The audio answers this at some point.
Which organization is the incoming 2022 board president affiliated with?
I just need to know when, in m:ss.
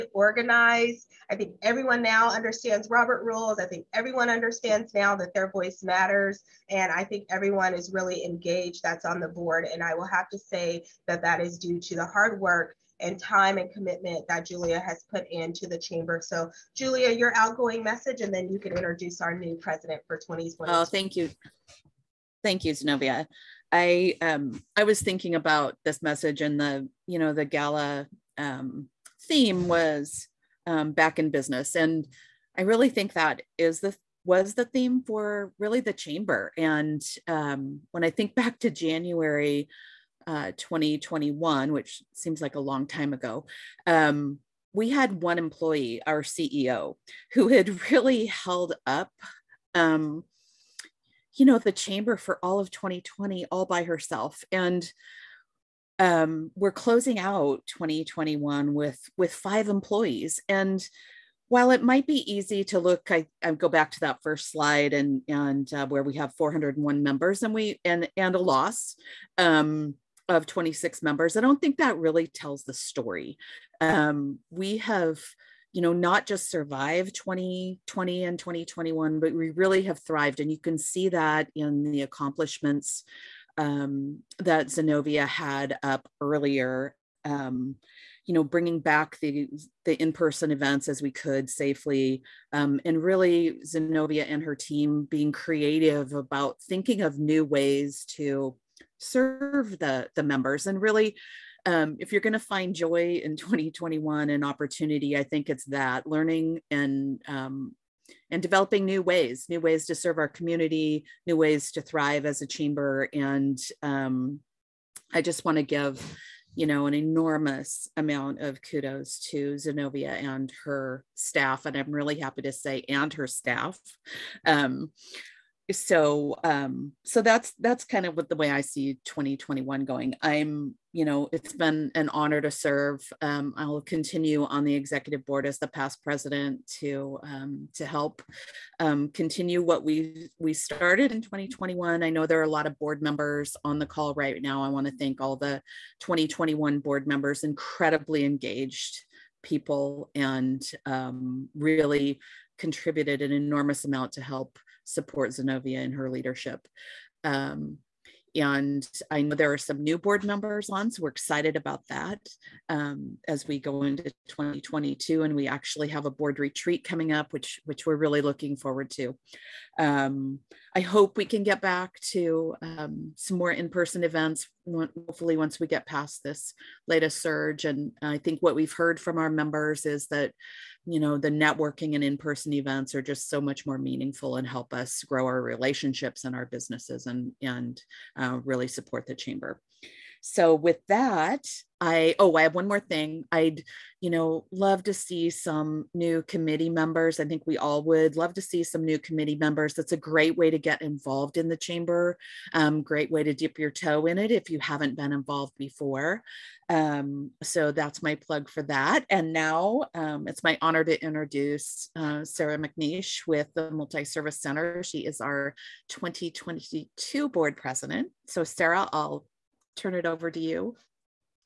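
3:33.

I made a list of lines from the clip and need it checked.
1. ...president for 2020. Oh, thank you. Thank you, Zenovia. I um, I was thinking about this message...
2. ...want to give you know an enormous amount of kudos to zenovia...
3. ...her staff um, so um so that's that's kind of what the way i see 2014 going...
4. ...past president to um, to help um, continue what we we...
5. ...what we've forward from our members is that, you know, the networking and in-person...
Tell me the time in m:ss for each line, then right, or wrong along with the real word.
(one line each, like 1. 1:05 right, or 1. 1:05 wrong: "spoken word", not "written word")
1. 0:19 right
2. 1:55 right
3. 2:03 wrong: "2021", not "2014"
4. 2:15 right
5. 2:58 wrong: "heard", not "forward".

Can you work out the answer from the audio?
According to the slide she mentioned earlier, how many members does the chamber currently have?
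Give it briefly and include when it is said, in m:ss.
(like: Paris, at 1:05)
401, at 1:06.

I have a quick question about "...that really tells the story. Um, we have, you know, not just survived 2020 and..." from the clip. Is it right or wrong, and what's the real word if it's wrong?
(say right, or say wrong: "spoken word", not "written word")
right.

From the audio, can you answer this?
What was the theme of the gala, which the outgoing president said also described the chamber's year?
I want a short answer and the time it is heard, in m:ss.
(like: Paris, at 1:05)
Back in business, at 0:30.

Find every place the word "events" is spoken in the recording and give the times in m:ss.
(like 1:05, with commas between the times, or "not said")
1:30, 2:54, 3:02.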